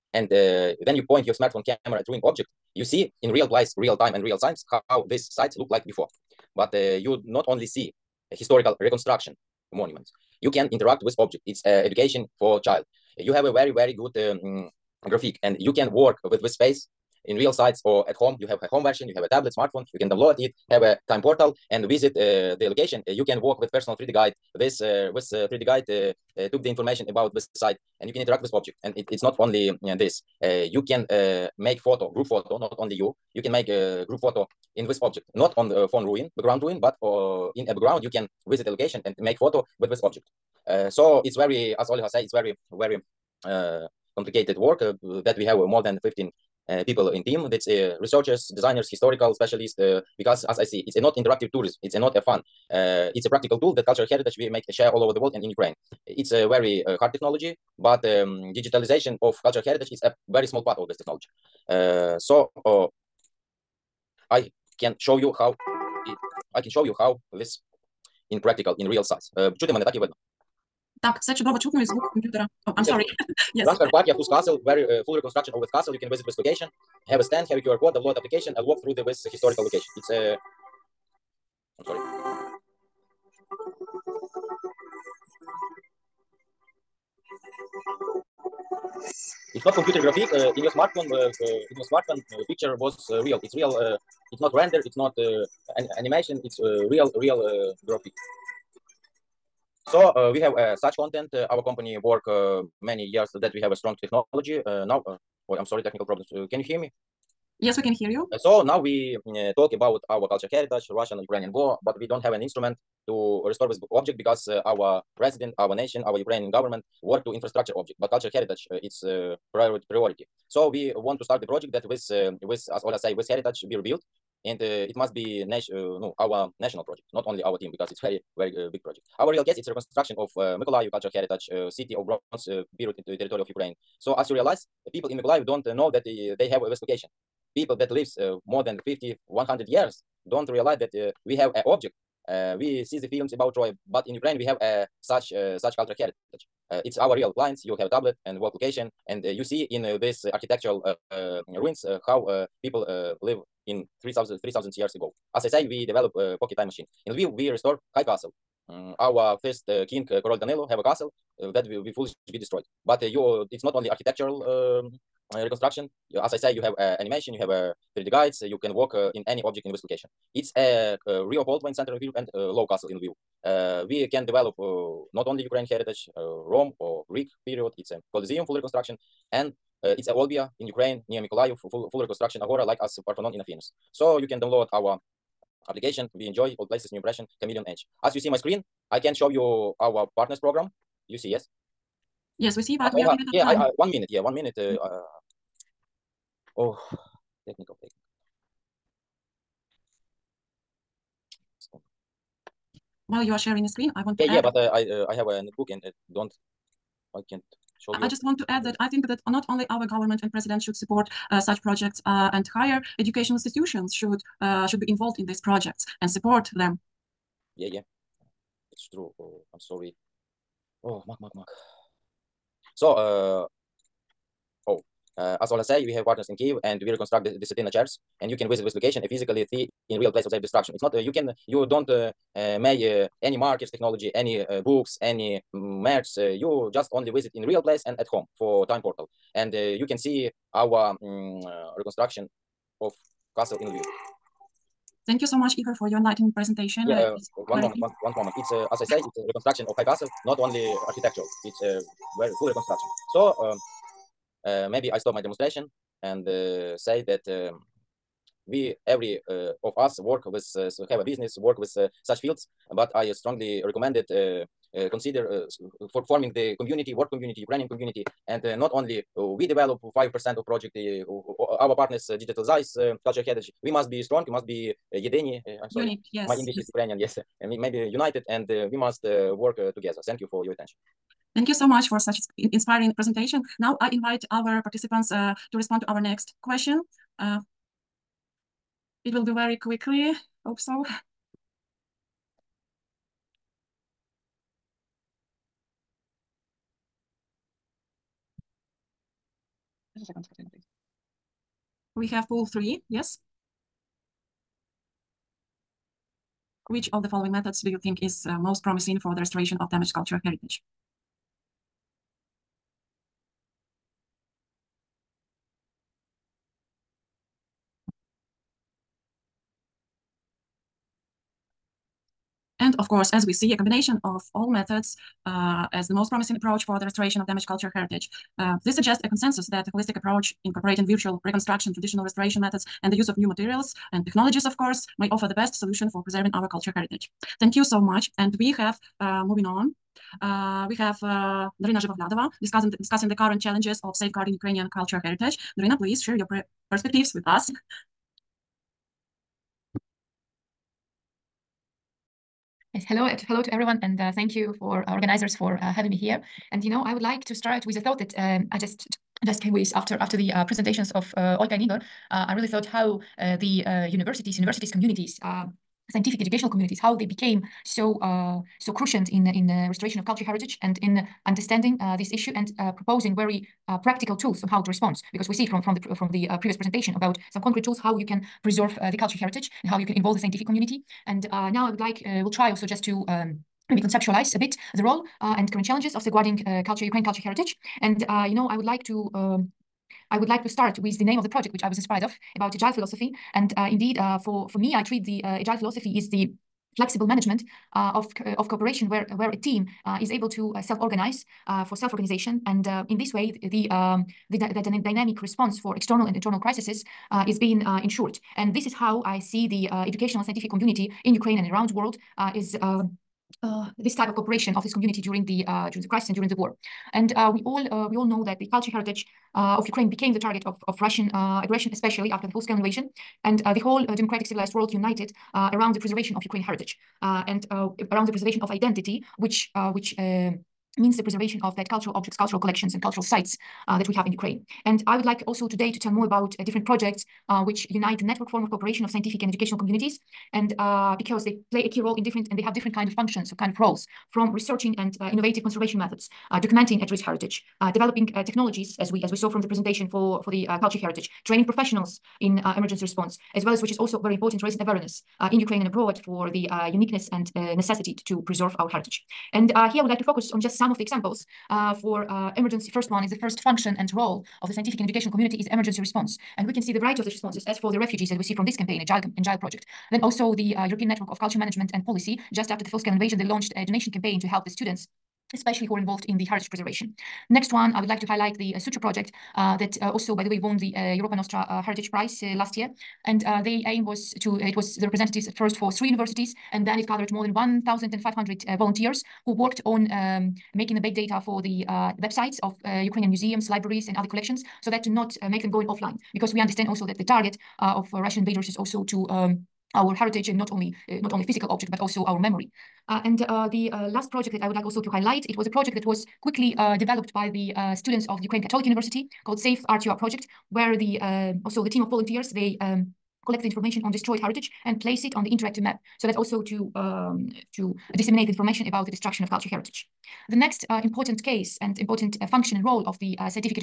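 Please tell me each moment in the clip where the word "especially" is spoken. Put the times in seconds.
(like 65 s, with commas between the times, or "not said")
421 s, 475 s.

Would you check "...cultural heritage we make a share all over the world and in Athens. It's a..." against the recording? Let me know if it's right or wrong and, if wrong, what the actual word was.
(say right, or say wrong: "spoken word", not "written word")
wrong: "Ukraine", not "Athens".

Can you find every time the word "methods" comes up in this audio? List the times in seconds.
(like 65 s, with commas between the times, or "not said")
307 s, 324 s, 332 s, 445 s.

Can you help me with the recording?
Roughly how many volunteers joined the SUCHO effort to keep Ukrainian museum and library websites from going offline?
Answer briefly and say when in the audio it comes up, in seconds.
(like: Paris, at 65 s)
more than 1500, at 487 s.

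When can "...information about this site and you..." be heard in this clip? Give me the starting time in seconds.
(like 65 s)
26 s.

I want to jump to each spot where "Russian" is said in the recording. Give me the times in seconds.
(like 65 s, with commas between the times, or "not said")
110 s, 420 s, 497 s.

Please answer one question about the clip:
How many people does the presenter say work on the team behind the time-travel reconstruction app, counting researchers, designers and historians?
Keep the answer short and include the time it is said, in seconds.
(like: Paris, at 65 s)
more than 15, at 45 s.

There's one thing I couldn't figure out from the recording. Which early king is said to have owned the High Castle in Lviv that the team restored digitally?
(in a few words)
Danilo.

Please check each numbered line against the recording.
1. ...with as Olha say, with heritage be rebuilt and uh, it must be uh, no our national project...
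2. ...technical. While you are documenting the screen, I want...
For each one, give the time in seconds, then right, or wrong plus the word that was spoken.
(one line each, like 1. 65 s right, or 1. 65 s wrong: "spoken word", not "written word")
1. 122 s right
2. 197 s wrong: "sharing", not "documenting".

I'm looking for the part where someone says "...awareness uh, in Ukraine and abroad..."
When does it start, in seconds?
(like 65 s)
454 s.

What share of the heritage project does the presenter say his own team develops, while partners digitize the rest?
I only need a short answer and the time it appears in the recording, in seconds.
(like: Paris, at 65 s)
5%, at 269 s.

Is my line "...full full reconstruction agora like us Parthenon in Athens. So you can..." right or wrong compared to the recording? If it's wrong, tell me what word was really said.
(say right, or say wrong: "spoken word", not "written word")
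right.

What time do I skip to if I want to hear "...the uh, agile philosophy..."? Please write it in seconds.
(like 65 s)
395 s.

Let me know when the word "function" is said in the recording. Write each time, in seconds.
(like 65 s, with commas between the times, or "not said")
442 s, 463 s, 522 s.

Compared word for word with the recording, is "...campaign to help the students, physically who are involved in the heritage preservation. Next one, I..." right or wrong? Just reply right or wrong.
wrong.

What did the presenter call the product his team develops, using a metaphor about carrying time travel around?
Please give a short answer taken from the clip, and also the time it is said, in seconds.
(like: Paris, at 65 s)
pocket time machine, at 156 s.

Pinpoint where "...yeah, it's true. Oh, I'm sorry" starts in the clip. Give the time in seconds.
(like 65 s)
217 s.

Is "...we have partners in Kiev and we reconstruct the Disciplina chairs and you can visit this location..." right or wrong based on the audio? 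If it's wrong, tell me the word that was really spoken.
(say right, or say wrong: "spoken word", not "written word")
right.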